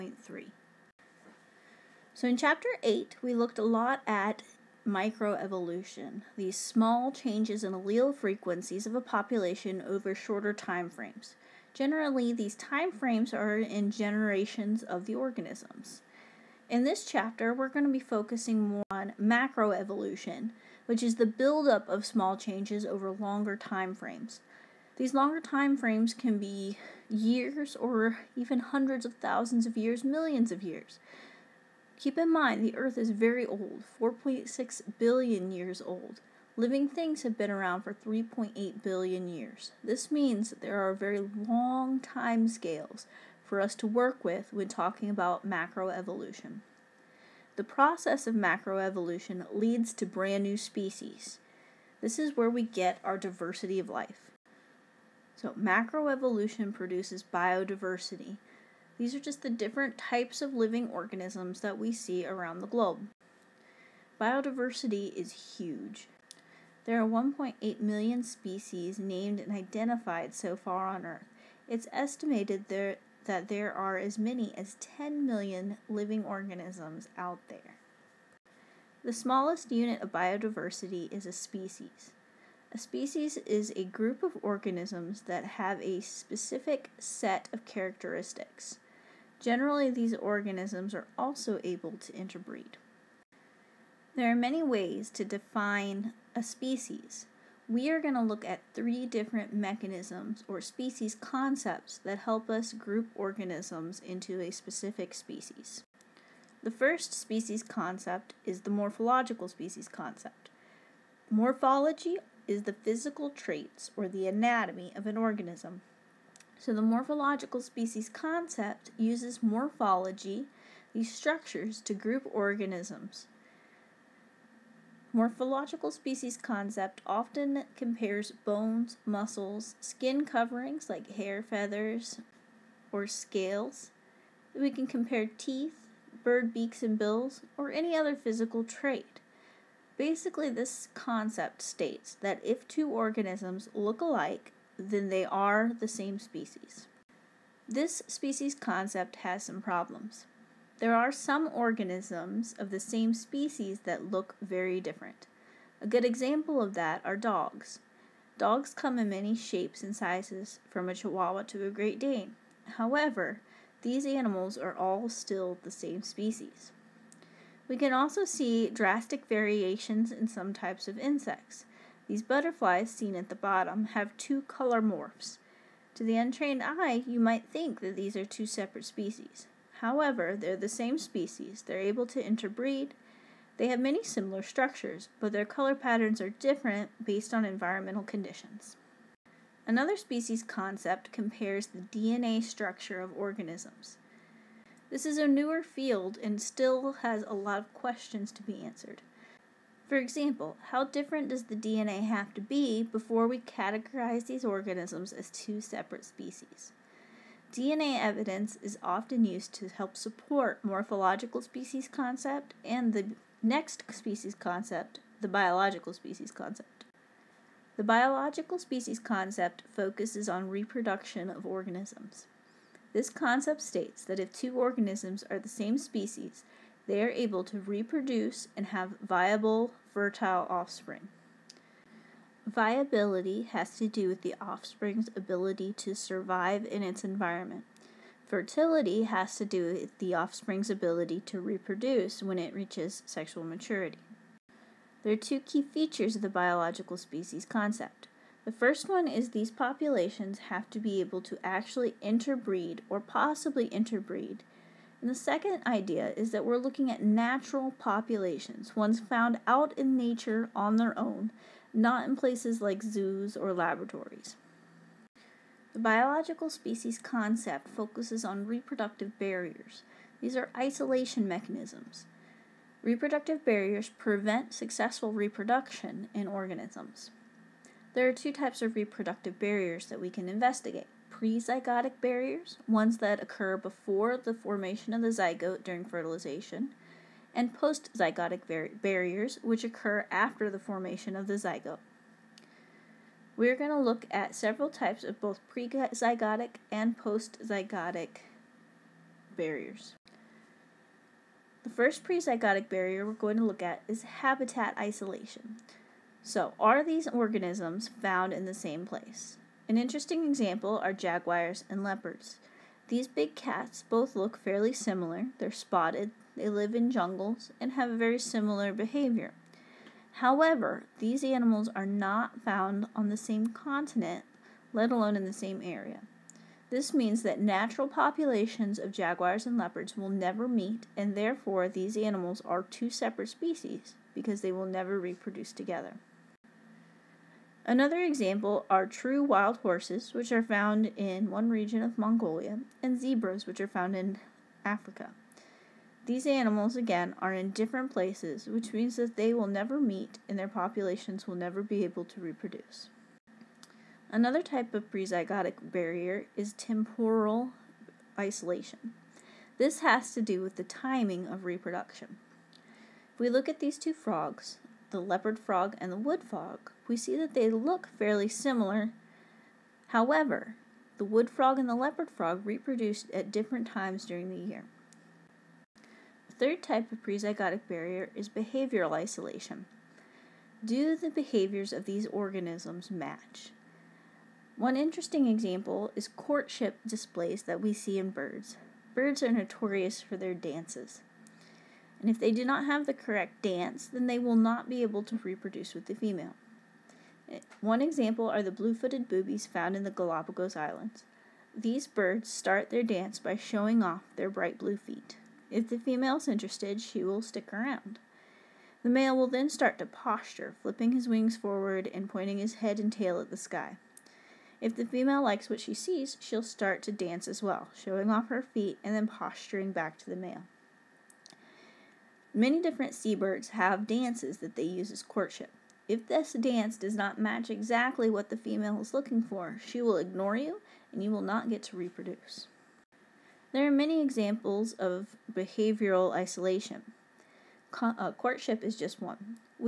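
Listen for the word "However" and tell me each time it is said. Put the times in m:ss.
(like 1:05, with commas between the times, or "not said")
2:42, 2:59, 5:20, 6:09.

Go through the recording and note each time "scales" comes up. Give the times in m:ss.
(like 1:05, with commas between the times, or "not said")
0:42, 2:13.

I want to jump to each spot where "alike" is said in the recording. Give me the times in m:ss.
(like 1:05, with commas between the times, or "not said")
2:24.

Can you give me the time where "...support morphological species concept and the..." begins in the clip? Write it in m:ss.
3:29.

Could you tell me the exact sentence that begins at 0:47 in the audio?
The process of macroevolution leads to brand new species.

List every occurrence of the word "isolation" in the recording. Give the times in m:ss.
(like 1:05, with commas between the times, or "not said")
4:30, 5:04, 5:58, 6:18, 7:16.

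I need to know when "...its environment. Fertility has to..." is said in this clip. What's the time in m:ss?
3:56.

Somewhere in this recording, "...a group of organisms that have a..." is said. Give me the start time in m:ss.
1:23.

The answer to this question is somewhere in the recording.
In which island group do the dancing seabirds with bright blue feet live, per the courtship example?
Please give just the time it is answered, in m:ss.
6:39.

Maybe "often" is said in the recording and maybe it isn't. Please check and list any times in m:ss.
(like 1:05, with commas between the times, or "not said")
2:07, 3:28.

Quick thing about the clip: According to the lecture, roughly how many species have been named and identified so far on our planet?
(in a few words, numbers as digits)
1.8 million.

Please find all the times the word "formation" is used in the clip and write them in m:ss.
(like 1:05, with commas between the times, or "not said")
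4:44, 4:50.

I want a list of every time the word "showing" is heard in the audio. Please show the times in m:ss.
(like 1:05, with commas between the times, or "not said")
6:43, 6:57.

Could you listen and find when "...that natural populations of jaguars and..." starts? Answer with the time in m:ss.
5:27.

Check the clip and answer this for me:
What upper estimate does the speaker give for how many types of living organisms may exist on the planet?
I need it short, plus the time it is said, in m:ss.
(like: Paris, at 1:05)
10 million, at 1:14.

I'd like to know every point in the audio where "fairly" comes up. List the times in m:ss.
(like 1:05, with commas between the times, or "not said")
5:14, 6:07.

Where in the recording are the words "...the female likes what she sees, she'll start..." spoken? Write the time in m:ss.
6:54.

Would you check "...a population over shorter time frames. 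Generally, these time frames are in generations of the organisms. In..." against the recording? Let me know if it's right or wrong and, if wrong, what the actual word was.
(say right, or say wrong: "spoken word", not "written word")
right.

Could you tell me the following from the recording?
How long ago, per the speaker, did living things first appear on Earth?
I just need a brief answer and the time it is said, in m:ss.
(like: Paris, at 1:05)
3.8 billion years, at 0:37.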